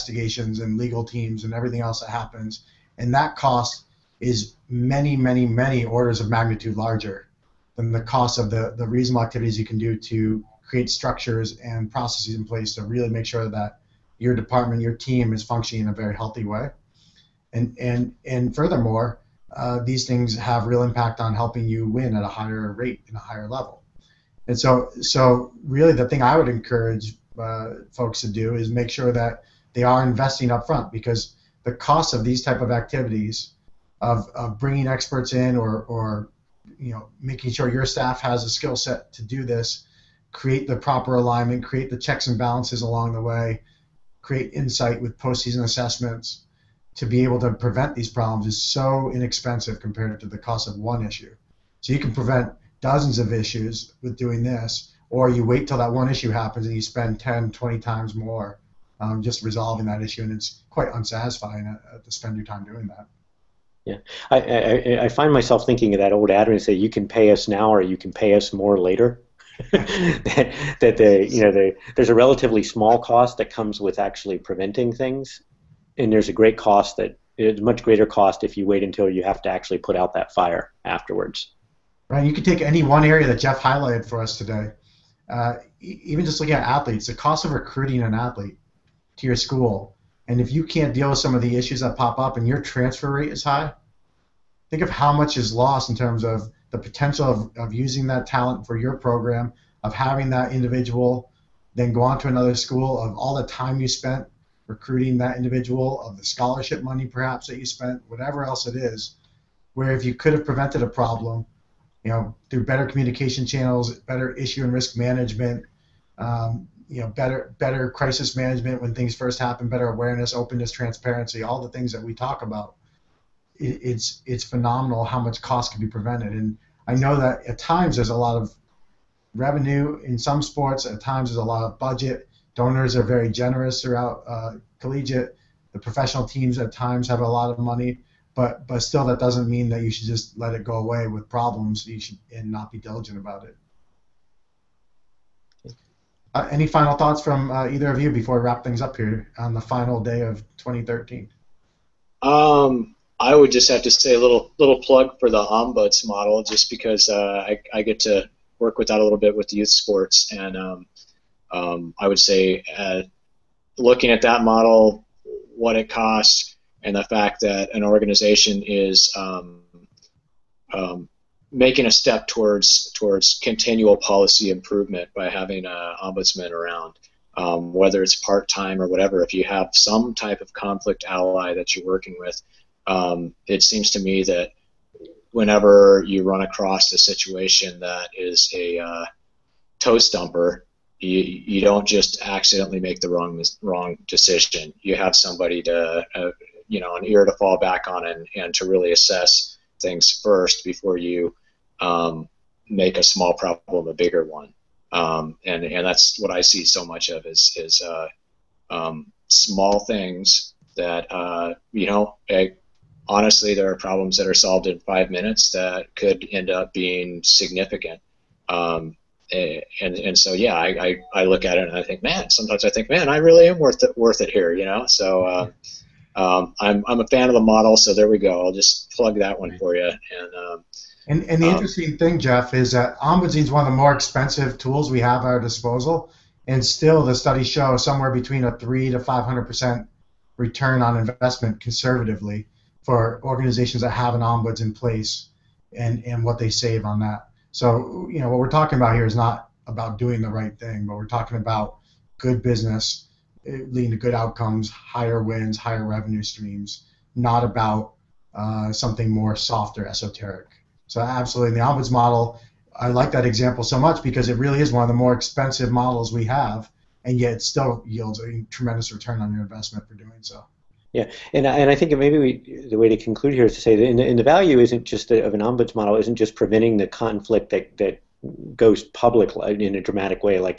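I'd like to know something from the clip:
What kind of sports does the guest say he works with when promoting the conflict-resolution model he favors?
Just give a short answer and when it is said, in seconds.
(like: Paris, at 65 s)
youth sports, at 159 s.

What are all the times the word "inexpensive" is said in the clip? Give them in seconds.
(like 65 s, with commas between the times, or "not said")
49 s.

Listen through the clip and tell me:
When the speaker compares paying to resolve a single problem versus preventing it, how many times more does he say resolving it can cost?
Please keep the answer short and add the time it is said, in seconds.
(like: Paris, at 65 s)
10 20 times, at 57 s.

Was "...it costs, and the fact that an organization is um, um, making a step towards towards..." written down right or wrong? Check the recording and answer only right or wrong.
right.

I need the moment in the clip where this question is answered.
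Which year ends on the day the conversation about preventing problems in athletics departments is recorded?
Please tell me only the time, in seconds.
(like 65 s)
150 s.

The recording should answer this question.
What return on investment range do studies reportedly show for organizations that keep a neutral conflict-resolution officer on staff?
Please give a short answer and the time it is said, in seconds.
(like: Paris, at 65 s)
300 to 500 percent, at 238 s.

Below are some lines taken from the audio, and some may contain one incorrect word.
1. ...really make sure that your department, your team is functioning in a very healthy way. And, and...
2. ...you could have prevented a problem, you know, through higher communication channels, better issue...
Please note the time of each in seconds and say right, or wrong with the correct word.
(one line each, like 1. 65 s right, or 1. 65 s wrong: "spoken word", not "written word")
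1. 12 s right
2. 110 s wrong: "better", not "higher".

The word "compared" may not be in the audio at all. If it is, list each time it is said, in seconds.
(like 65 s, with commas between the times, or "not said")
49 s.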